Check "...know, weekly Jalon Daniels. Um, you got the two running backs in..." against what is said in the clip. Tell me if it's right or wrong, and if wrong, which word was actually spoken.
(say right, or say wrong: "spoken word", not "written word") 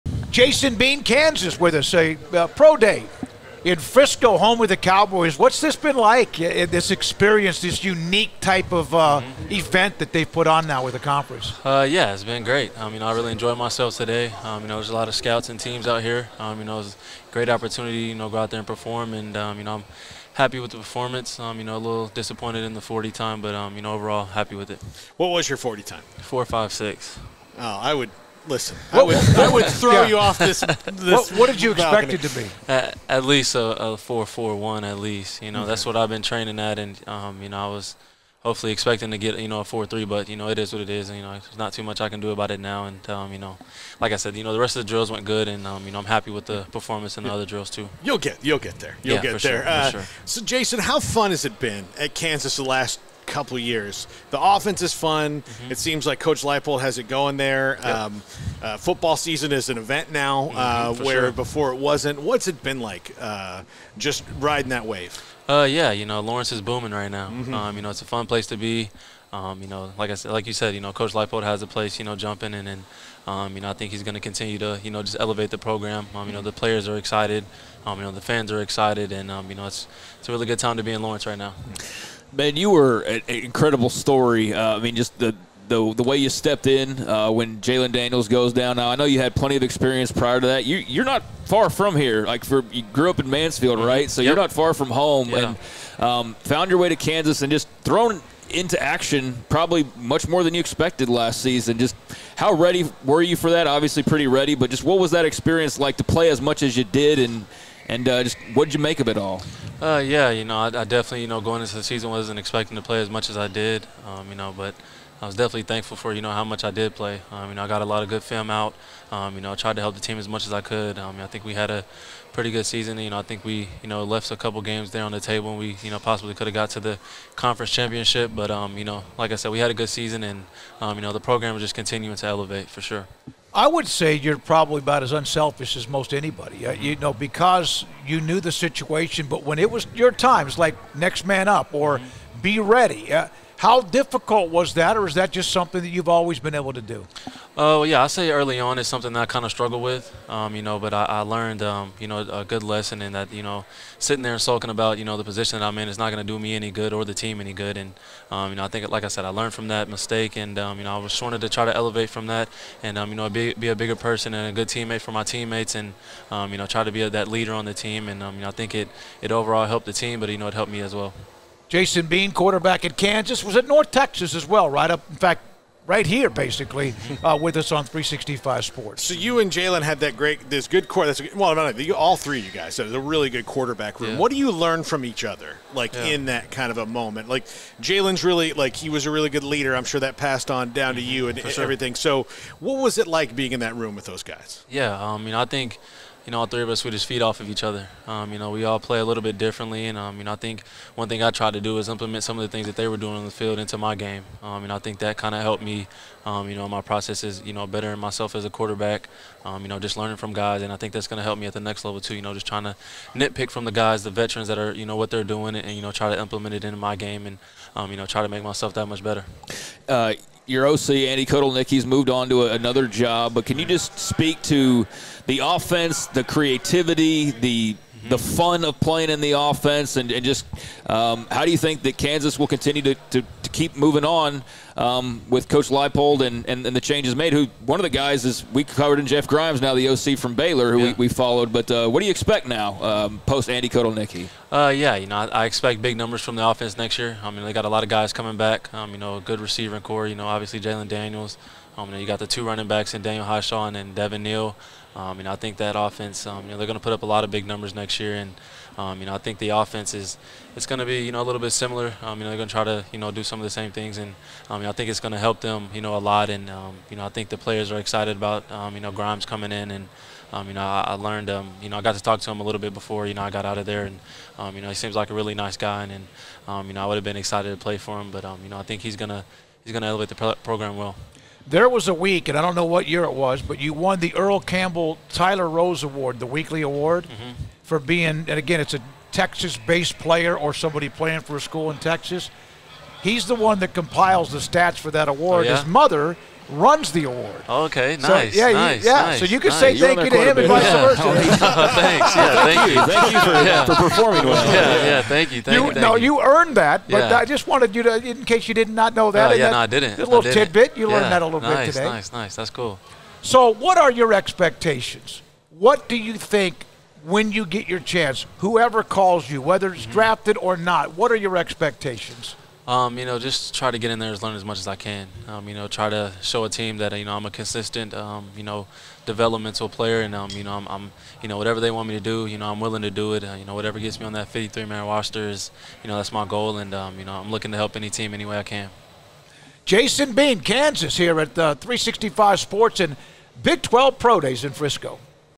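wrong: "obviously", not "weekly".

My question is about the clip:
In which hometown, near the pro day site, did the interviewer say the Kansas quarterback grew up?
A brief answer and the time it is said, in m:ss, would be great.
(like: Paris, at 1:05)
Mansfield, at 1:33.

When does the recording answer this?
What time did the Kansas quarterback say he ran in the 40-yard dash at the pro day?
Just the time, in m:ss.
0:26.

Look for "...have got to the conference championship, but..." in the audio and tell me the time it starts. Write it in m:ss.
2:06.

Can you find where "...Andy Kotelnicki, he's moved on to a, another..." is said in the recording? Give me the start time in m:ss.
3:40.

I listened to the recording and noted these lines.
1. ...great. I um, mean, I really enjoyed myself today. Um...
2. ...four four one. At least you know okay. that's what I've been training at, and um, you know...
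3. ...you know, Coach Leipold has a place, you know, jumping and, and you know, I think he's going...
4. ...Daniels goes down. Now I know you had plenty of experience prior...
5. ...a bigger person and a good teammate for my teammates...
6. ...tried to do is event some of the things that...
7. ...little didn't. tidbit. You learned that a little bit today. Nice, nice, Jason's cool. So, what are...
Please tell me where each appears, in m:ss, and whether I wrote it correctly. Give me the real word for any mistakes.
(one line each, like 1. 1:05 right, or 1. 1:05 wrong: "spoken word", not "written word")
1. 0:12 right
2. 0:33 right
3. 1:10 right
4. 1:27 right
5. 2:43 right
6. 3:21 wrong: "implement", not "event"
7. 5:10 wrong: "That", not "Jason".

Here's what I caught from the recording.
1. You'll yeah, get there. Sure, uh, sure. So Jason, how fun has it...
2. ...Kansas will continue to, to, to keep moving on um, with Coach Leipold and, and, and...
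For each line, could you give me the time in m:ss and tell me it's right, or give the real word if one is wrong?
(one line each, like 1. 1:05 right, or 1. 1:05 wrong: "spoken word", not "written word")
1. 0:49 right
2. 3:51 right.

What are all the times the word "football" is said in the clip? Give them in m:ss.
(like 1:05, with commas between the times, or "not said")
0:58.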